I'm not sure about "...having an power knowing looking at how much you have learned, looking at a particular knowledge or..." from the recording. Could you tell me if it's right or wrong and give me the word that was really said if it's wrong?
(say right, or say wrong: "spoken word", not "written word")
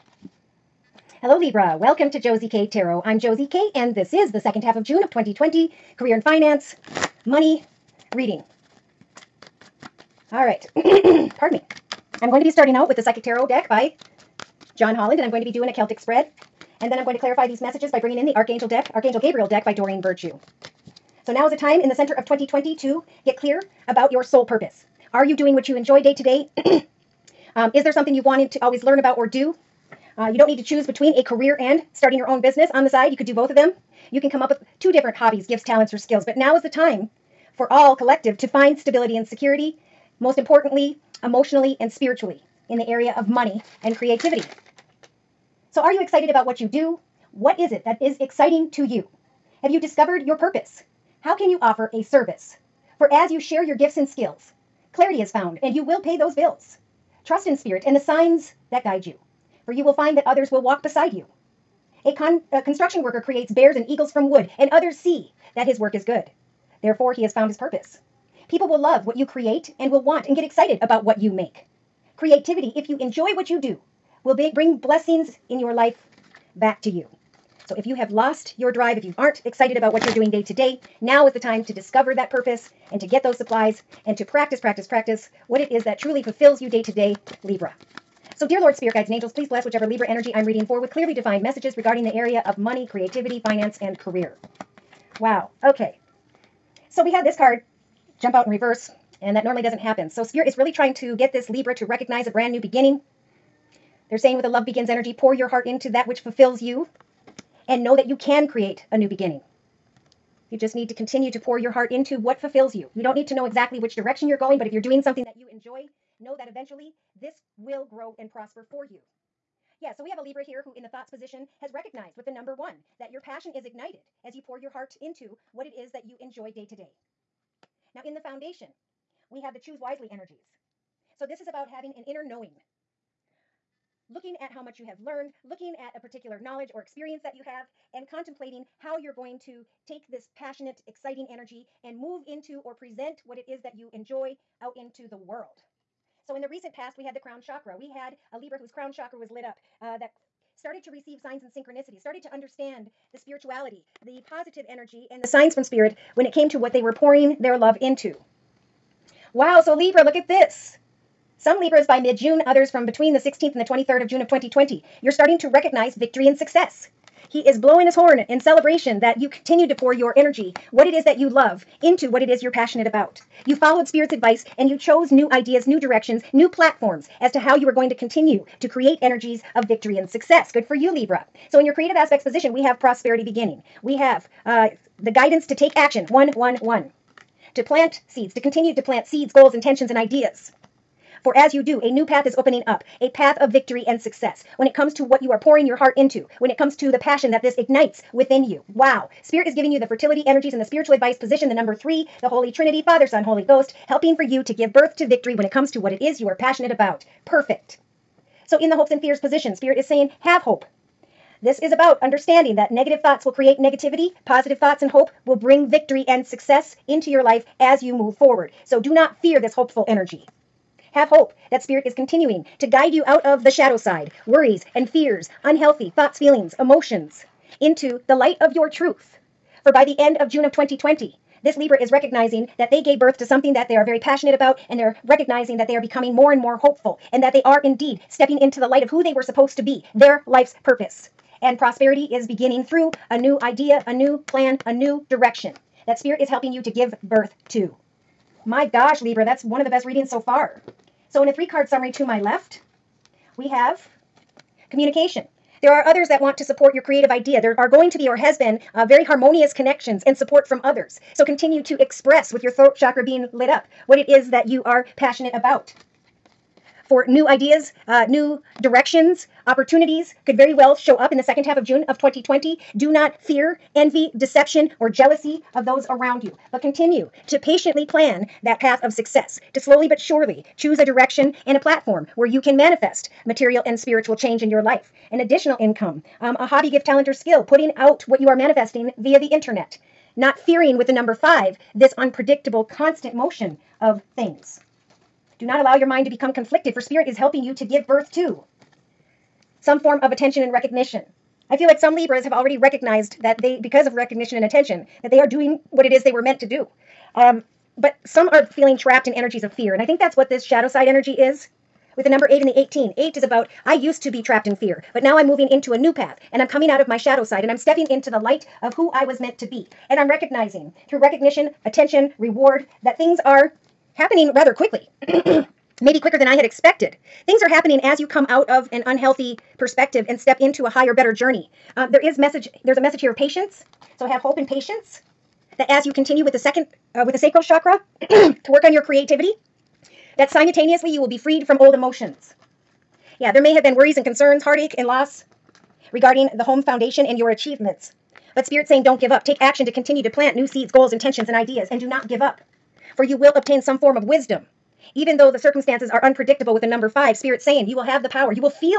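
wrong: "inner", not "power".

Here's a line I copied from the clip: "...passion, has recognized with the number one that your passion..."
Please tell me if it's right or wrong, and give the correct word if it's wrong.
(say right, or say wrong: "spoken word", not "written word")
wrong: "position", not "passion".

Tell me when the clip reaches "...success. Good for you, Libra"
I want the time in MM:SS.
03:00.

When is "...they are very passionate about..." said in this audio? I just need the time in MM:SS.
03:53.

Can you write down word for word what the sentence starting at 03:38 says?
So do not fear this hopeful energy.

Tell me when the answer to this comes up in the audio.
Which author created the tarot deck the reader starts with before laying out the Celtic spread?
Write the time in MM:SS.
00:14.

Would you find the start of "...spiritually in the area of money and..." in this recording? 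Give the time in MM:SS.
00:41.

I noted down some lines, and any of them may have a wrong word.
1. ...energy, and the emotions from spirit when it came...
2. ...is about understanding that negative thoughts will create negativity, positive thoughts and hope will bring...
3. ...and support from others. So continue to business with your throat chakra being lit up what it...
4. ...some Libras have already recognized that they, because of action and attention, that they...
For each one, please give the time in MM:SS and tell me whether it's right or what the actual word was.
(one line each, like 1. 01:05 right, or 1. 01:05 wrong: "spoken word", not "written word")
1. 02:34 wrong: "signs", not "emotions"
2. 03:31 right
3. 04:20 wrong: "express", not "business"
4. 05:01 wrong: "recognition", not "action".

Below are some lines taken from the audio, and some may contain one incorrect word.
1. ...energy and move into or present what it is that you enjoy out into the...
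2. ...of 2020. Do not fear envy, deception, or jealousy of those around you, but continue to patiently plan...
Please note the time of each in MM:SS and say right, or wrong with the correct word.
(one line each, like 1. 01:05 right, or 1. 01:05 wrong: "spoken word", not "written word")
1. 02:21 right
2. 04:31 right.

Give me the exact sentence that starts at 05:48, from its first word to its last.
But Spirit saying, don't give up.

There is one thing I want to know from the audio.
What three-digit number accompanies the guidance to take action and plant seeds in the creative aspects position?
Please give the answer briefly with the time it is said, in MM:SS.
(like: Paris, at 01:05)
111, at 03:06.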